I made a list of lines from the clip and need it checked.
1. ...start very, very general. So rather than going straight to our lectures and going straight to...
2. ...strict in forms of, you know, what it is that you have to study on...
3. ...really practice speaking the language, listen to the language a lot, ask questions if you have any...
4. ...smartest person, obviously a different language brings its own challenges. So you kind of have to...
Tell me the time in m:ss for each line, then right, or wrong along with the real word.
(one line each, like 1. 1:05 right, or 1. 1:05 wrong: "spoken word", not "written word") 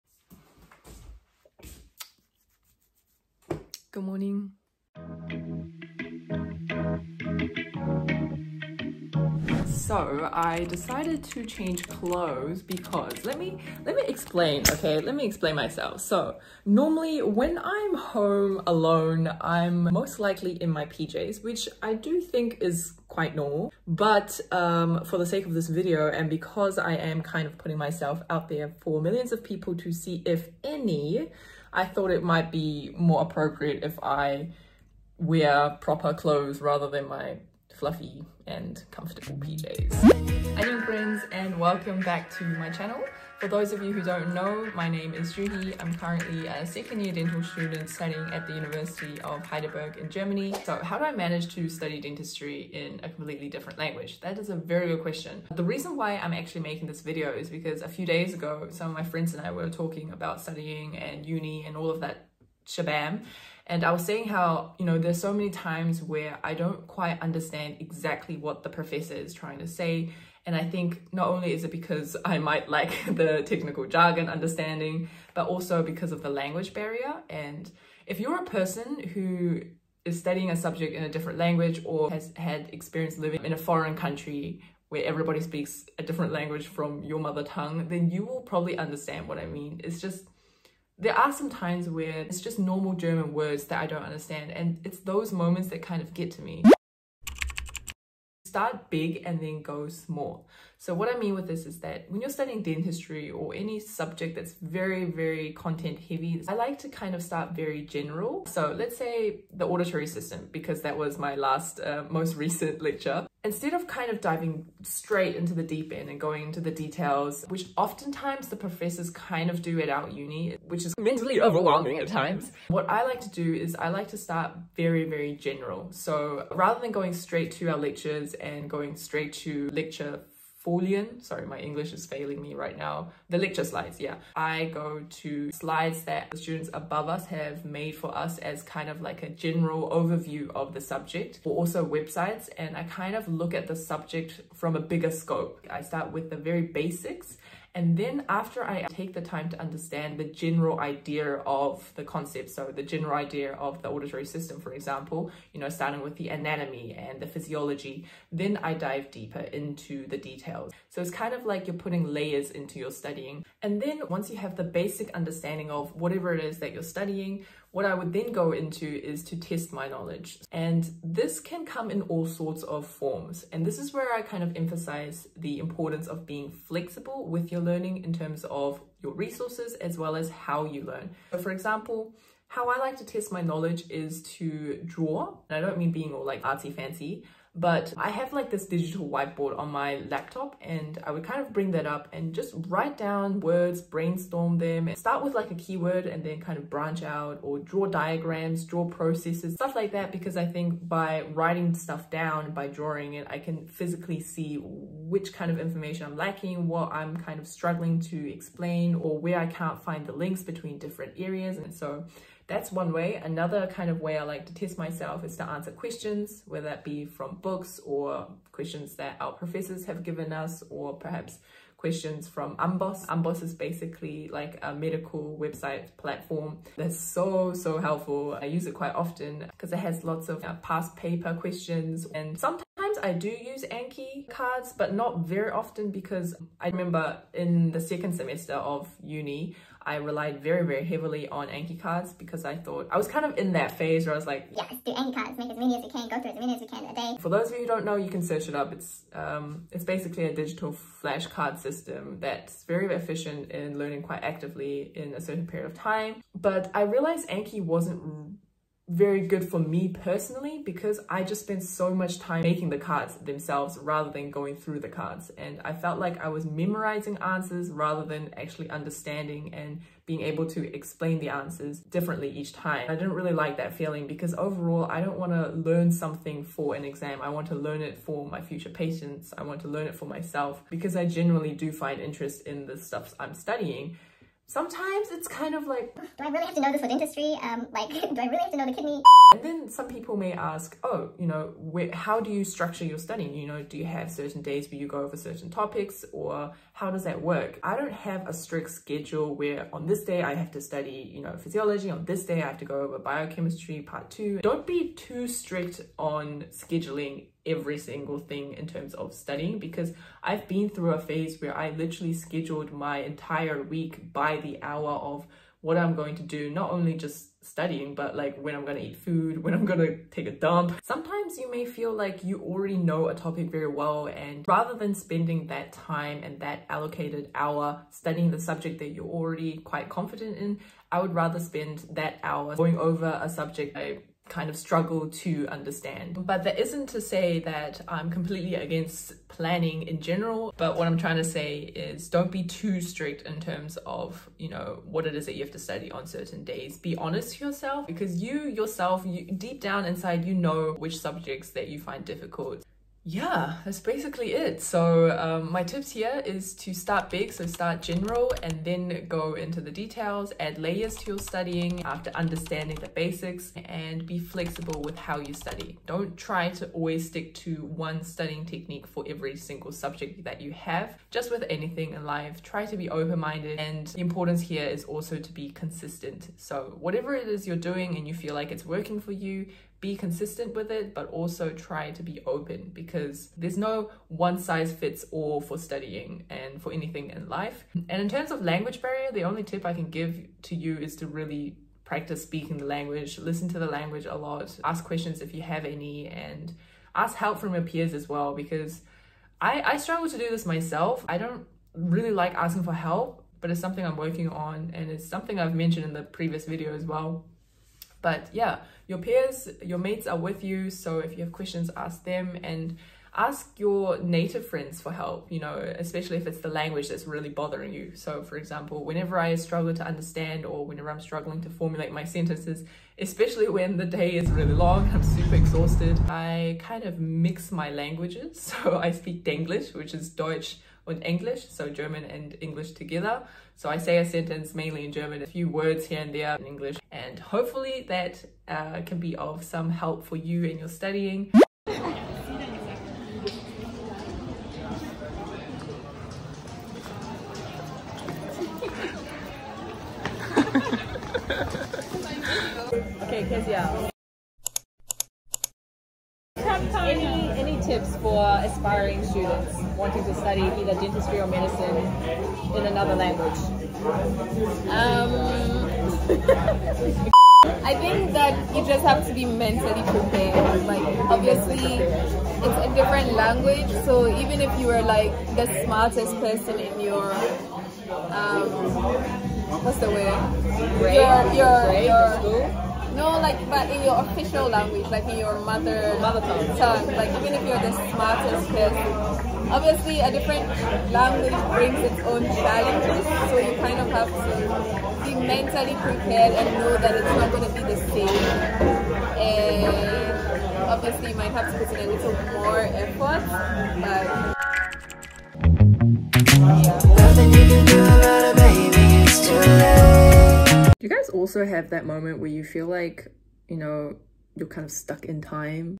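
1. 2:04 right
2. 5:42 wrong: "terms", not "forms"
3. 6:31 right
4. 8:07 right.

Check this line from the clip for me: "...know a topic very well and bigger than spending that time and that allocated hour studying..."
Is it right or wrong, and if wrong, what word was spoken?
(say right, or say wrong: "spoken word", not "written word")
wrong: "rather", not "bigger".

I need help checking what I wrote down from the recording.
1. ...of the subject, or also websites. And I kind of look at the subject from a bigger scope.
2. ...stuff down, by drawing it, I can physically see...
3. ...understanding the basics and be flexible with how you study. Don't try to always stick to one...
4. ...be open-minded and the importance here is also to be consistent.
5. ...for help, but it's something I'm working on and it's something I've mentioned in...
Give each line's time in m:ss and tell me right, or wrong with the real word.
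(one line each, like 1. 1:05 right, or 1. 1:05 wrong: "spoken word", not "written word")
1. 2:20 right
2. 3:21 right
3. 6:02 right
4. 6:12 right
5. 6:42 right.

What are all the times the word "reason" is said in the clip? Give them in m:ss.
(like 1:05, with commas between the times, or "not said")
0:55.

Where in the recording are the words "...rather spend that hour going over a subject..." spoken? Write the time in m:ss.
5:31.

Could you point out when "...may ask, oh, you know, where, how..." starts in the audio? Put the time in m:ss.
4:50.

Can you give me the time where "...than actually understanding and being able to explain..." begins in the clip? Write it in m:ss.
4:28.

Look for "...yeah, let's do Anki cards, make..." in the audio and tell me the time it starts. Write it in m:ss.
4:04.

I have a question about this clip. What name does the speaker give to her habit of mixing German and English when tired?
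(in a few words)
Denglish.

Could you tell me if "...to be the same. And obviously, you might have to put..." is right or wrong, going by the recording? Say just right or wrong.
right.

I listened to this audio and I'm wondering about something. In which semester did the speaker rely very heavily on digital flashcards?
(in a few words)
Second semester.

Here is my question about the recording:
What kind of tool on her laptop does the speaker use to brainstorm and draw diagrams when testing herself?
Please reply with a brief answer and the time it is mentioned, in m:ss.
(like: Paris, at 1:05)
Digital whiteboard, at 3:08.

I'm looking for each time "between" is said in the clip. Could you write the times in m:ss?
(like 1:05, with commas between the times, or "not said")
3:30.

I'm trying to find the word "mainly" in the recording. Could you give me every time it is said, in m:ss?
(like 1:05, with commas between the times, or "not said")
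7:14.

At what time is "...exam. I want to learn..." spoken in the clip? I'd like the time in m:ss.
4:36.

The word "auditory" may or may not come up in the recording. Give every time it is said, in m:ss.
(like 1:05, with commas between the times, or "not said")
1:49, 2:33.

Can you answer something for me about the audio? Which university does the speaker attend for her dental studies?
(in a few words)
University of Heidelberg.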